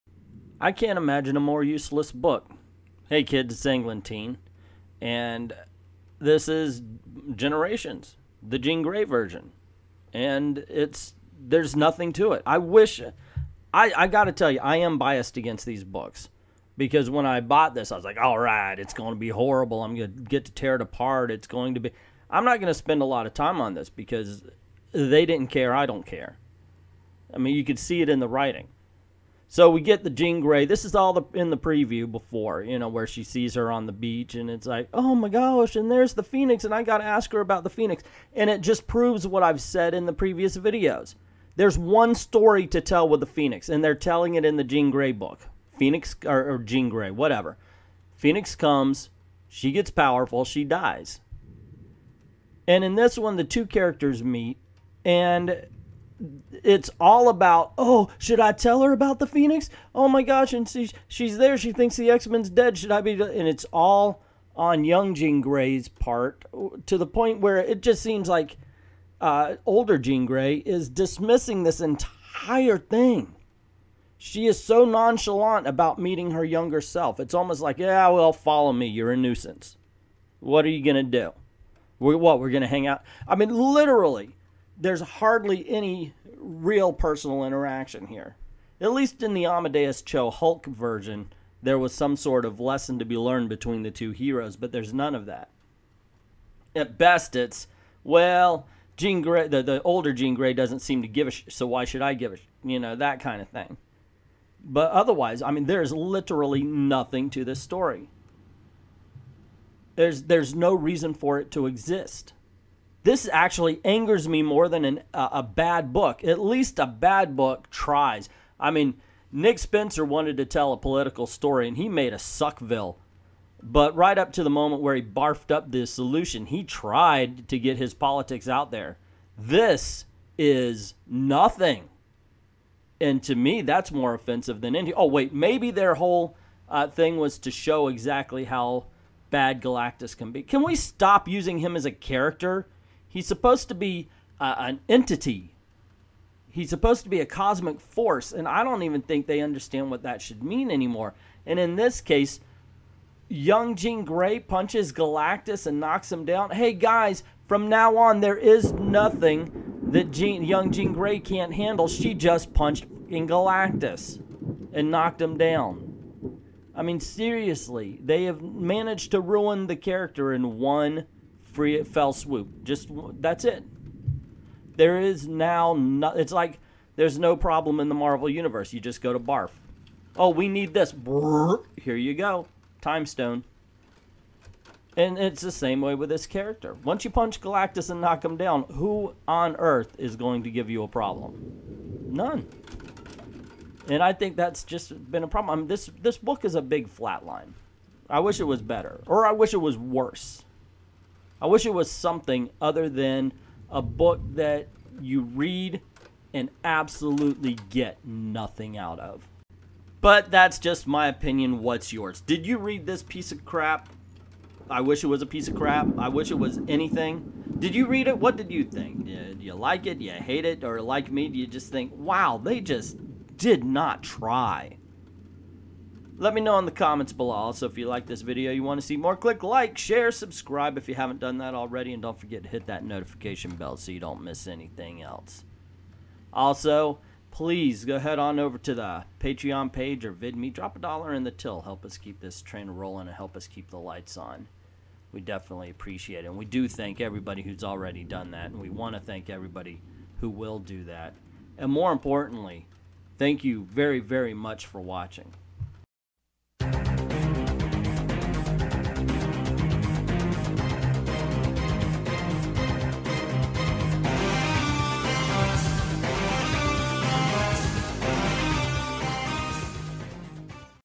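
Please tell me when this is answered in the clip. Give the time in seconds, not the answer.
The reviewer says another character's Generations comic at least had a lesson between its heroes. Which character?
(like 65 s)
89 s.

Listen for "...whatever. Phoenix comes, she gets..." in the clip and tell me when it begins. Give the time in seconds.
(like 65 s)
47 s.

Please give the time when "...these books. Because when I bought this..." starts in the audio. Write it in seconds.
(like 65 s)
15 s.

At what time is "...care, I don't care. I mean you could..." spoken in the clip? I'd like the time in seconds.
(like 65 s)
25 s.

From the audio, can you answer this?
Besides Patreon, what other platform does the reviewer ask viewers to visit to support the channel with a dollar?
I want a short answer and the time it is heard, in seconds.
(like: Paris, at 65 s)
VidMe, at 240 s.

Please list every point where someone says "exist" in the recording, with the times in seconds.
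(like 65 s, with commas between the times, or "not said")
111 s.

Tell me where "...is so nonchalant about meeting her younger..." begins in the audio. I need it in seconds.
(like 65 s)
74 s.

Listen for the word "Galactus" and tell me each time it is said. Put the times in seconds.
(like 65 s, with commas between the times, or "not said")
139 s, 154 s, 163 s, 187 s.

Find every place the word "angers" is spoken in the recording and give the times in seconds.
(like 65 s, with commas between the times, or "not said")
113 s.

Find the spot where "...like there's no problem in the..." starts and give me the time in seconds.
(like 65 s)
176 s.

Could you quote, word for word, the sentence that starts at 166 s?
I mean, seriously, they have managed to ruin the character in one free it fell swoop.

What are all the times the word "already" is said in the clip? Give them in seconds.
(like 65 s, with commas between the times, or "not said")
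231 s, 247 s.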